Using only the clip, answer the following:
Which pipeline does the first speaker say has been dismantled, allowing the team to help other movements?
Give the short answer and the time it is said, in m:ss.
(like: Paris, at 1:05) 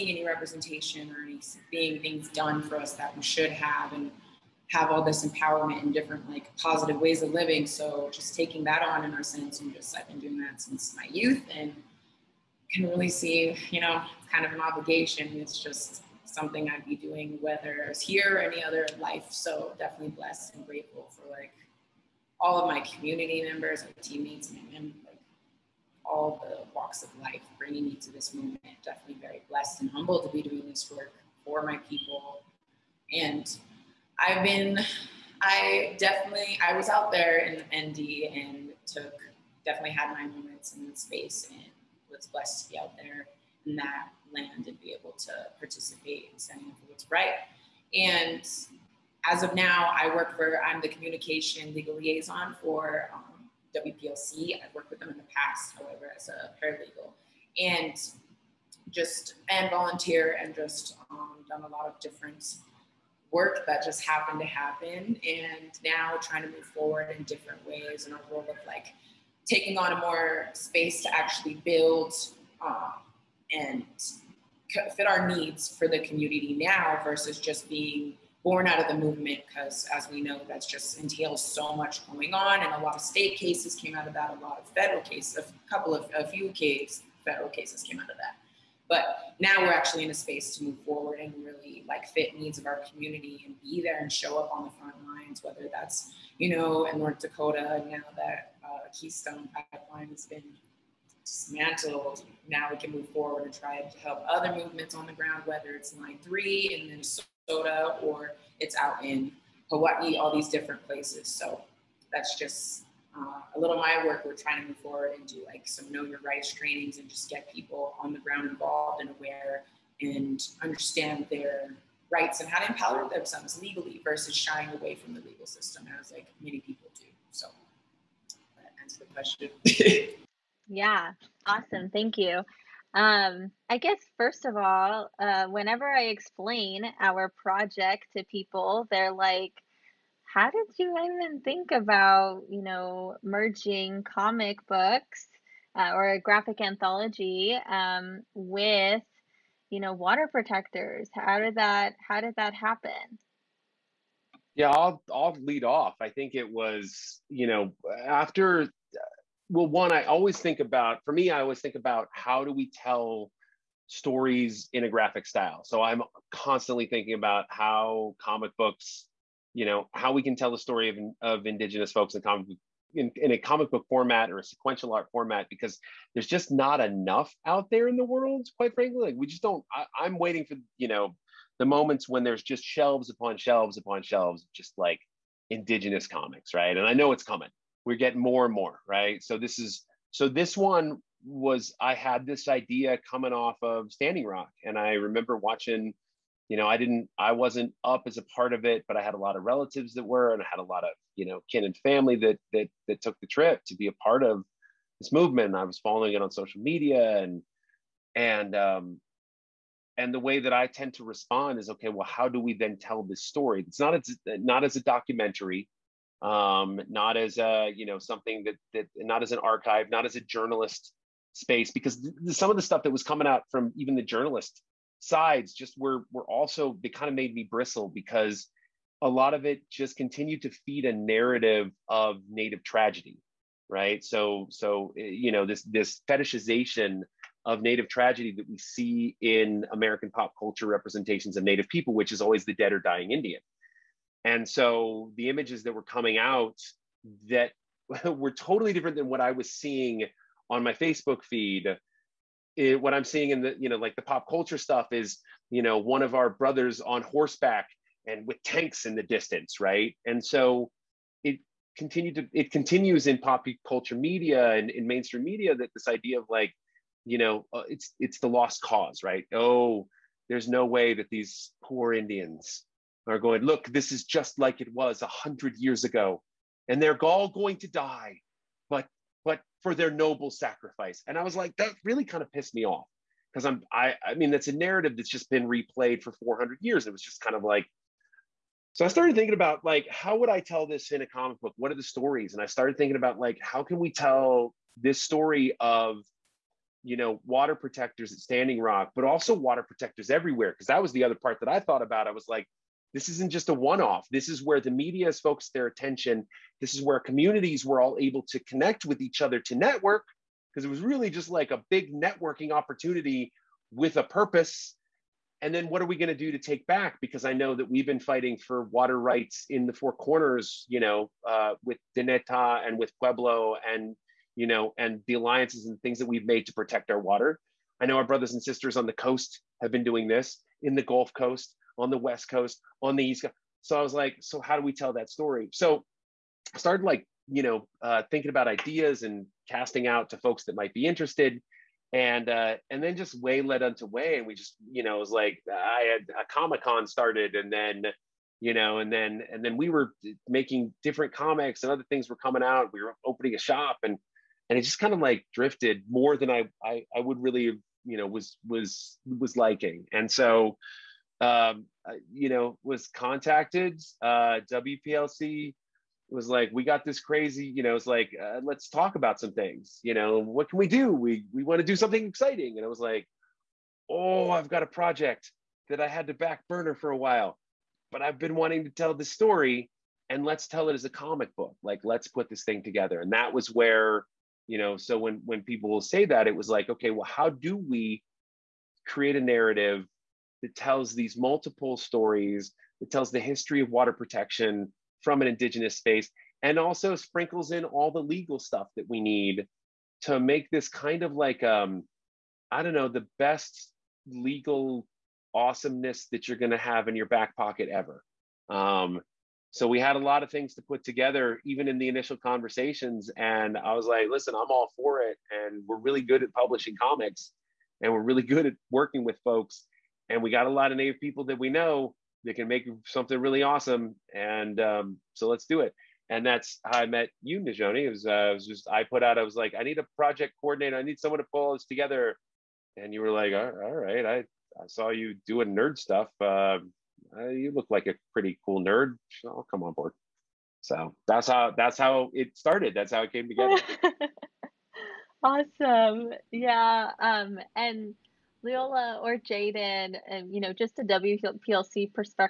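Keystone Pipeline, at 1:38.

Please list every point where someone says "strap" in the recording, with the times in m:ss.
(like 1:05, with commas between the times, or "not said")
not said.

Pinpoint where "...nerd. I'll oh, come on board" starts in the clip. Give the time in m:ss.
7:18.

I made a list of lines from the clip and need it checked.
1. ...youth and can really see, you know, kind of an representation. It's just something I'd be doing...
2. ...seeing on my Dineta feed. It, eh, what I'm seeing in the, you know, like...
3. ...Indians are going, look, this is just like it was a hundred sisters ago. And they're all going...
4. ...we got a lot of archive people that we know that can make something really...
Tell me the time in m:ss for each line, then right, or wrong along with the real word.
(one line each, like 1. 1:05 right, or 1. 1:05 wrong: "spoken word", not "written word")
1. 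0:11 wrong: "obligation", not "representation"
2. 4:09 wrong: "Facebook", not "Dineta"
3. 4:31 wrong: "years", not "sisters"
4. 7:00 wrong: "native", not "archive".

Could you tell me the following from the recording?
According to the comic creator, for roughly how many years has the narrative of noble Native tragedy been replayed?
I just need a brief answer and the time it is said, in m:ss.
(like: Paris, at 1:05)
400 years, at 4:46.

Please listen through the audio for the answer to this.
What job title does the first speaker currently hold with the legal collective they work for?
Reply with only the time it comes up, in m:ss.
0:50.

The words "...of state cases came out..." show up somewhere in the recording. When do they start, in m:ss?
1:22.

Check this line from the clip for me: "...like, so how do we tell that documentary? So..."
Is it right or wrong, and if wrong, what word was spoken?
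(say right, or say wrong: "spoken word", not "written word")
wrong: "story", not "documentary".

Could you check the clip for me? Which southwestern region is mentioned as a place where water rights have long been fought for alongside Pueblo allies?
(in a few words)
Four Corners.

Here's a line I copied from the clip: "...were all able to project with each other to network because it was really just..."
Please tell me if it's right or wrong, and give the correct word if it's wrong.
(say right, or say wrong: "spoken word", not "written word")
wrong: "connect", not "project".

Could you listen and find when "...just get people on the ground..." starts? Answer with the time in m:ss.
1:57.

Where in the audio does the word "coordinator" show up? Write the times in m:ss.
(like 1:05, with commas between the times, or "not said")
7:10.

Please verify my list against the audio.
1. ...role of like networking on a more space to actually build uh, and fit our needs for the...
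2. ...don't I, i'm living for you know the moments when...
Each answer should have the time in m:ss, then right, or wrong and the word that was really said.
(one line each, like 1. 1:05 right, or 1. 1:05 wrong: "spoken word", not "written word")
1. 1:08 wrong: "taking", not "networking"
2. 2:59 wrong: "waiting", not "living".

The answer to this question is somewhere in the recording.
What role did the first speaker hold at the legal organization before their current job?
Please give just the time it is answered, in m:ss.
0:56.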